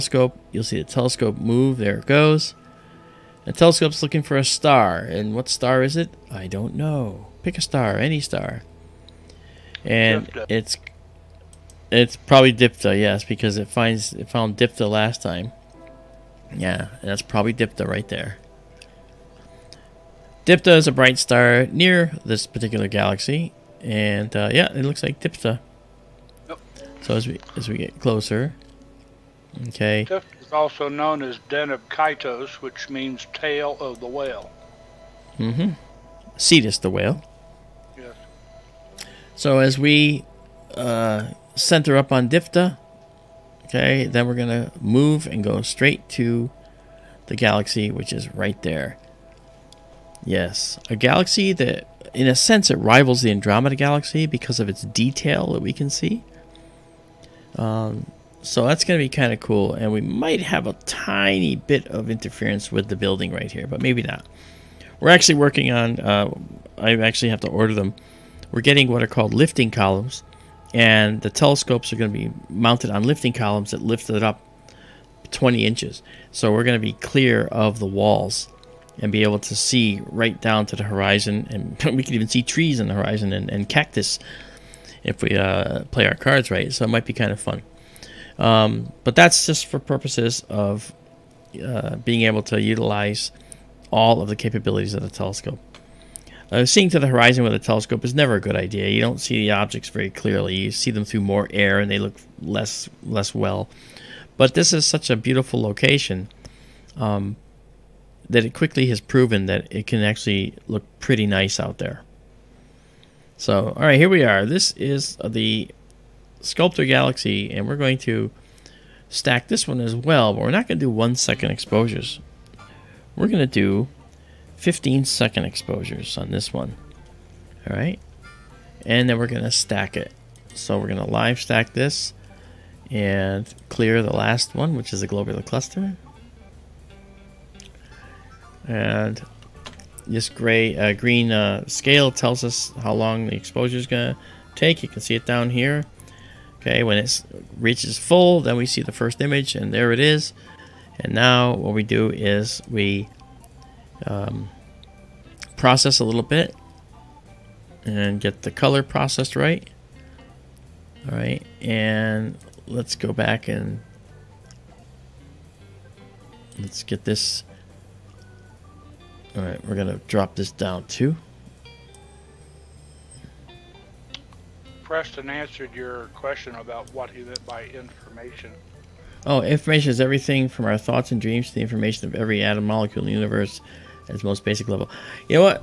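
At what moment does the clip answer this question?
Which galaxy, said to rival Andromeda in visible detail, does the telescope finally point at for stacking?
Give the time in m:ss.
1:56.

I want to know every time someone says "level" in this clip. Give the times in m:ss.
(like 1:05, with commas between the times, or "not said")
3:04.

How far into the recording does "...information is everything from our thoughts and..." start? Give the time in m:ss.
2:59.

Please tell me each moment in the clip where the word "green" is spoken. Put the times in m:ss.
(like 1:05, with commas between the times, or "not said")
2:20.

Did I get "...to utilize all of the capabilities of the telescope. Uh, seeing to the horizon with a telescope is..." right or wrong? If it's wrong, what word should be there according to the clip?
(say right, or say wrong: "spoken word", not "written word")
right.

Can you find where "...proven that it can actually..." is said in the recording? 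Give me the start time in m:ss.
1:49.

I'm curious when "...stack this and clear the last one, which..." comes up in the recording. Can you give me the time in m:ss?
2:11.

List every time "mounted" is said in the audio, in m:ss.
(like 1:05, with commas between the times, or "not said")
1:12.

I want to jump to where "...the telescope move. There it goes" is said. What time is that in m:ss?
0:00.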